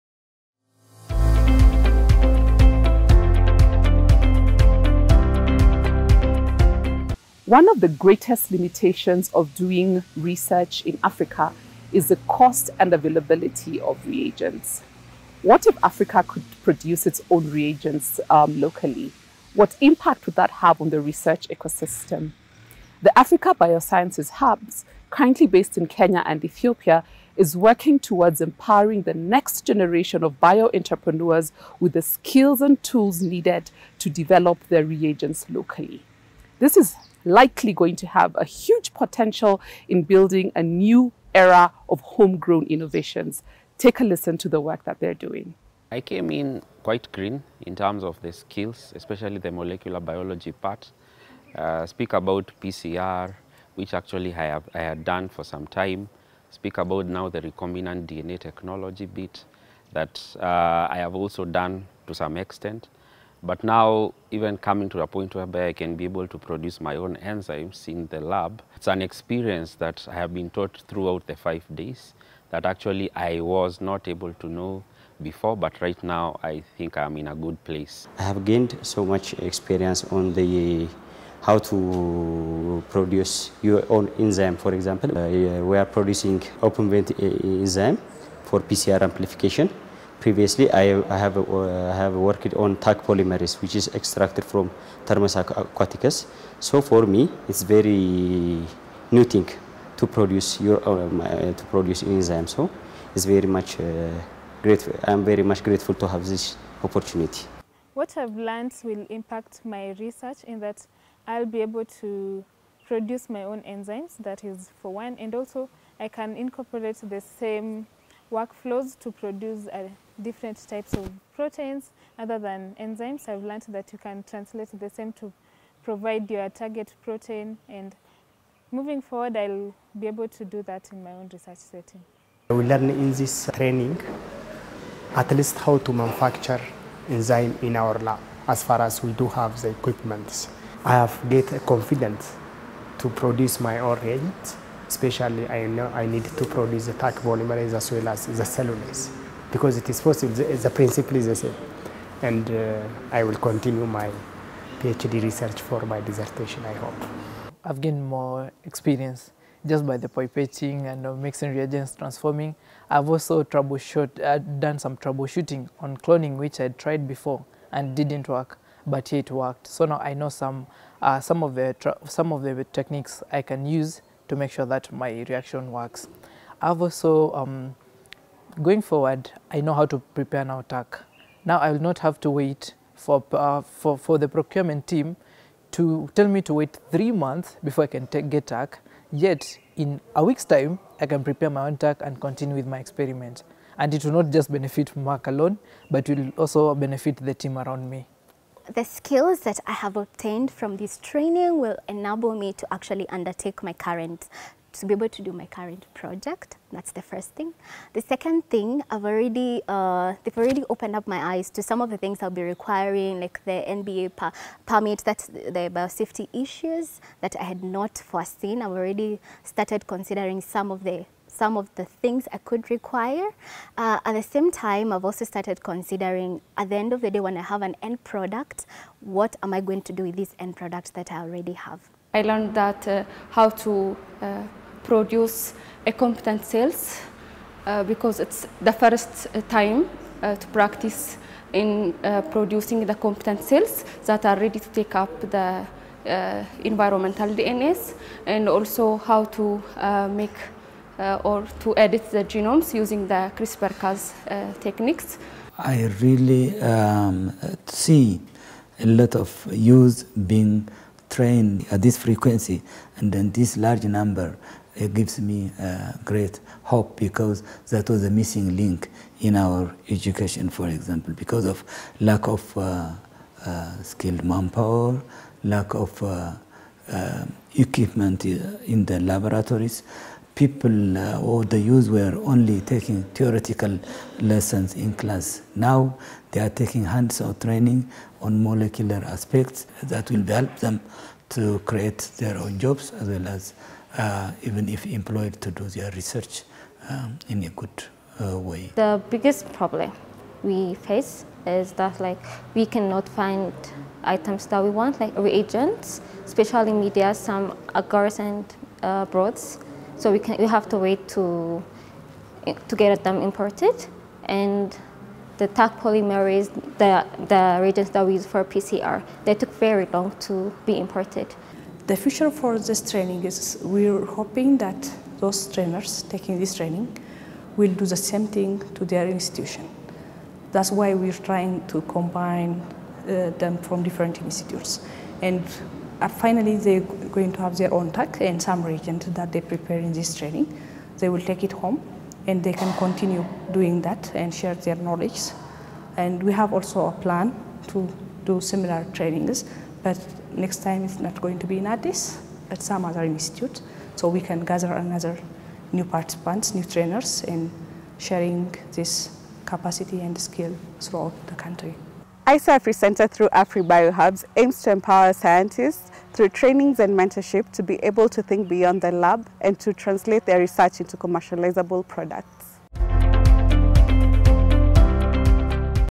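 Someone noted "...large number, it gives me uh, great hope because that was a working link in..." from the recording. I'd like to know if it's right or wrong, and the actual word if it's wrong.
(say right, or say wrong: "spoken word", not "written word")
wrong: "missing", not "working".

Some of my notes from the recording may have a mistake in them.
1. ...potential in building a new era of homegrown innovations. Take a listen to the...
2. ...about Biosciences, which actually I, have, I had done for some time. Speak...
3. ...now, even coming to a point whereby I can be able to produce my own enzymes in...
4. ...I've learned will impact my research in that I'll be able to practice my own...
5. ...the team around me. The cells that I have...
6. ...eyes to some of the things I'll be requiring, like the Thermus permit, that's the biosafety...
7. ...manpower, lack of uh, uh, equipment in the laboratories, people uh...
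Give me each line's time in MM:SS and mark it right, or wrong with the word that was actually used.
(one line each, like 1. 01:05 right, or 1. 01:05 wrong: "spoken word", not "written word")
1. 00:38 right
2. 00:52 wrong: "PCR", not "Biosciences"
3. 01:03 right
4. 01:48 wrong: "produce", not "practice"
5. 03:17 wrong: "skills", not "cells"
6. 03:31 wrong: "NBA", not "Thermus"
7. 04:34 right.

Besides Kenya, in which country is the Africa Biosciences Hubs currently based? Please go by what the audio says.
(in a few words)
Ethiopia.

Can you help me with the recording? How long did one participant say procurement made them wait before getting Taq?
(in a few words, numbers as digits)
3 months.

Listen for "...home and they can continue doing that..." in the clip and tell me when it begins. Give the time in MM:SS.
05:41.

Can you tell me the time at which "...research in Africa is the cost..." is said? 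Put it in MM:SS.
00:10.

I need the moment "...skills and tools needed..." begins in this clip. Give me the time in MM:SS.
00:32.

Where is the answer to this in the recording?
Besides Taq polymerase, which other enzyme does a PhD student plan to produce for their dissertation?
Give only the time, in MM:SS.
02:28.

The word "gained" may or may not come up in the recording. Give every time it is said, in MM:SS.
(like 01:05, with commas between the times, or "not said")
01:18, 02:37.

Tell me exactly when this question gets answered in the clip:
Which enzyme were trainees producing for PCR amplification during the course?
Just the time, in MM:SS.
01:26.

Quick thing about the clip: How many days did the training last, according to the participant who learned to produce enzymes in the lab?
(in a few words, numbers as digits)
5.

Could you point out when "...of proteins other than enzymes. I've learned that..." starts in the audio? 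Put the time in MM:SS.
02:00.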